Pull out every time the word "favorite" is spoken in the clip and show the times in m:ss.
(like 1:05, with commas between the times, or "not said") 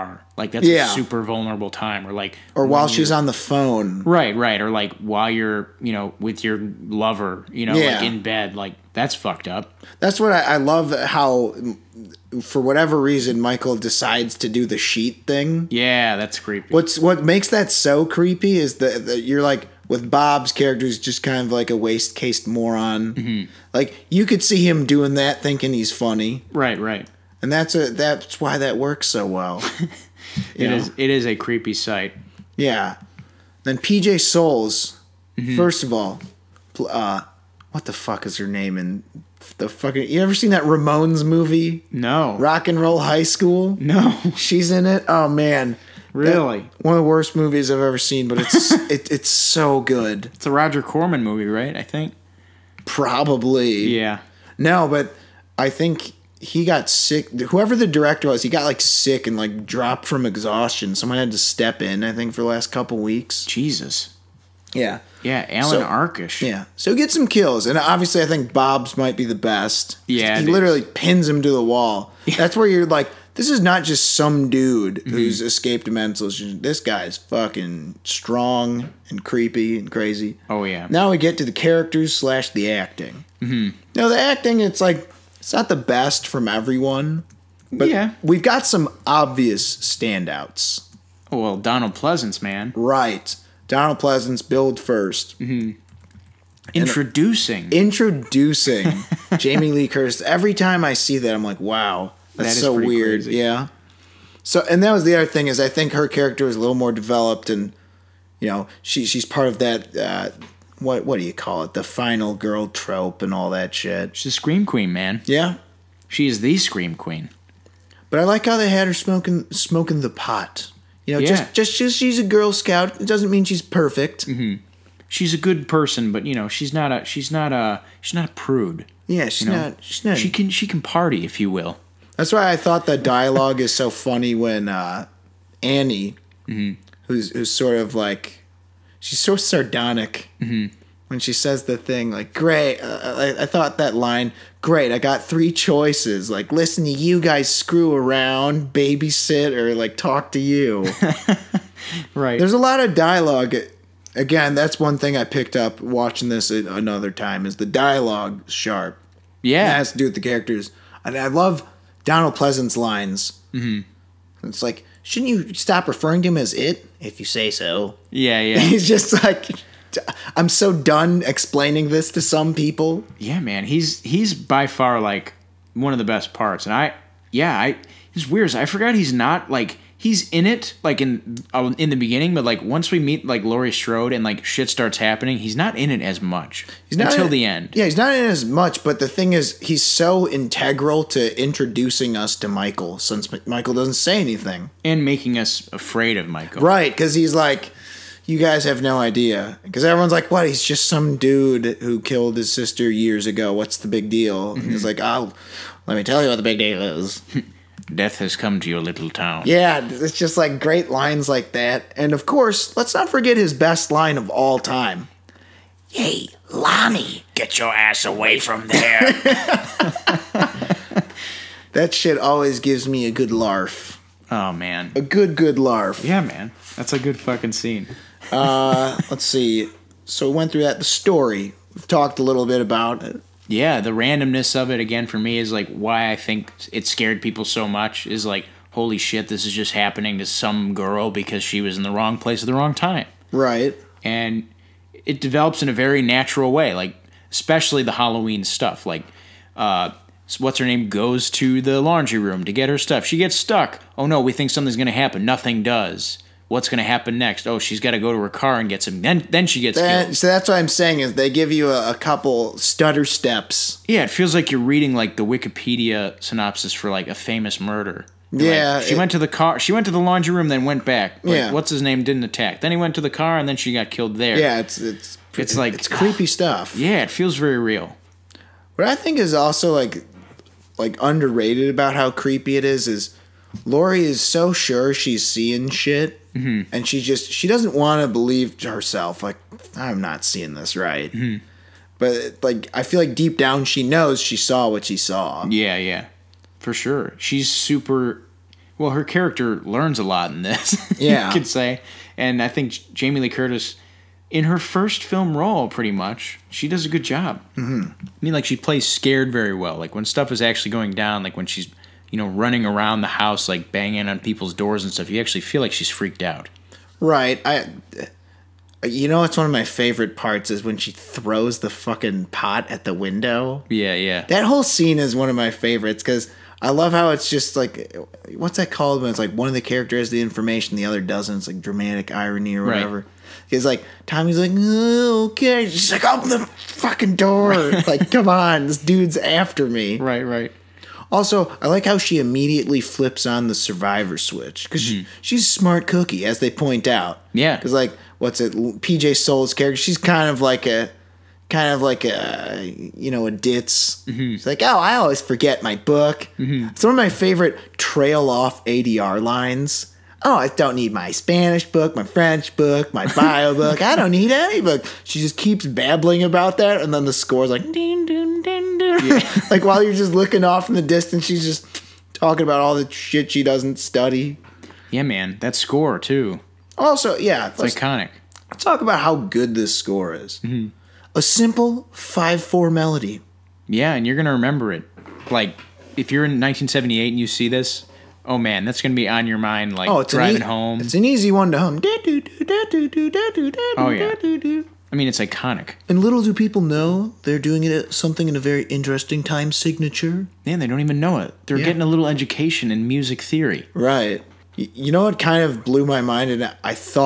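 5:19, 5:25, 5:57.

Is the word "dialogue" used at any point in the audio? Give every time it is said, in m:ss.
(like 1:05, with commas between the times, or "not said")
2:12, 2:32, 2:37.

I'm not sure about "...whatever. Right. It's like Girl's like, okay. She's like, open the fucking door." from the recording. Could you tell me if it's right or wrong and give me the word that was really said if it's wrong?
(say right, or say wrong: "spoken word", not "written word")
wrong: "Tommy", not "Girl".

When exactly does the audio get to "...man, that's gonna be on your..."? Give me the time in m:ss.
6:28.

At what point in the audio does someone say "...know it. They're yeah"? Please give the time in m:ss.
6:41.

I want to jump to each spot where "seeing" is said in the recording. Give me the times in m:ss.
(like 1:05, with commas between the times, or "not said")
4:45, 4:50.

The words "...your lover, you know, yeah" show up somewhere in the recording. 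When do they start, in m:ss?
0:06.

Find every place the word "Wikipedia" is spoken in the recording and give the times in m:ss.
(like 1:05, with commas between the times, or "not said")
4:25.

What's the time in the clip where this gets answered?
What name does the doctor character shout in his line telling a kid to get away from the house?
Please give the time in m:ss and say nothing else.
3:36.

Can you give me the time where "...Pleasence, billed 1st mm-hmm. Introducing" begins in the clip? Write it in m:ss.
1:33.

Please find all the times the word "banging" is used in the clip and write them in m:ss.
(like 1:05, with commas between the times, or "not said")
5:13.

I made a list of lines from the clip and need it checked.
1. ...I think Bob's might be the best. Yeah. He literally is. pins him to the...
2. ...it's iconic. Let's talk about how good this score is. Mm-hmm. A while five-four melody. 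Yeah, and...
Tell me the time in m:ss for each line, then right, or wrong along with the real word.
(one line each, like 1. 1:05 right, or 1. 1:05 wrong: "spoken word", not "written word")
1. 1:08 right
2. 6:17 wrong: "simple", not "while".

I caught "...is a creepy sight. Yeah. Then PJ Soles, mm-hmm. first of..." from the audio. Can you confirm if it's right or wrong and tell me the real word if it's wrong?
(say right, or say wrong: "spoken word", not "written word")
right.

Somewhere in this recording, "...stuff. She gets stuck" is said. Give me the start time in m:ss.
4:12.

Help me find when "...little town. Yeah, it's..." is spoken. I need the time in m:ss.
3:28.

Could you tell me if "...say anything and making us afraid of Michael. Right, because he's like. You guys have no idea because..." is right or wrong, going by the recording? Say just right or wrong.
right.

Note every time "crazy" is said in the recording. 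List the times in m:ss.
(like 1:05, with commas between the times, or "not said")
1:19, 1:43.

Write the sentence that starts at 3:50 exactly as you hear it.
So we went through that the story.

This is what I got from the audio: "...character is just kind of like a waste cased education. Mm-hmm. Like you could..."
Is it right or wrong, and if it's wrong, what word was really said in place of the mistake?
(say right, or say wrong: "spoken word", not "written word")
wrong: "moron", not "education".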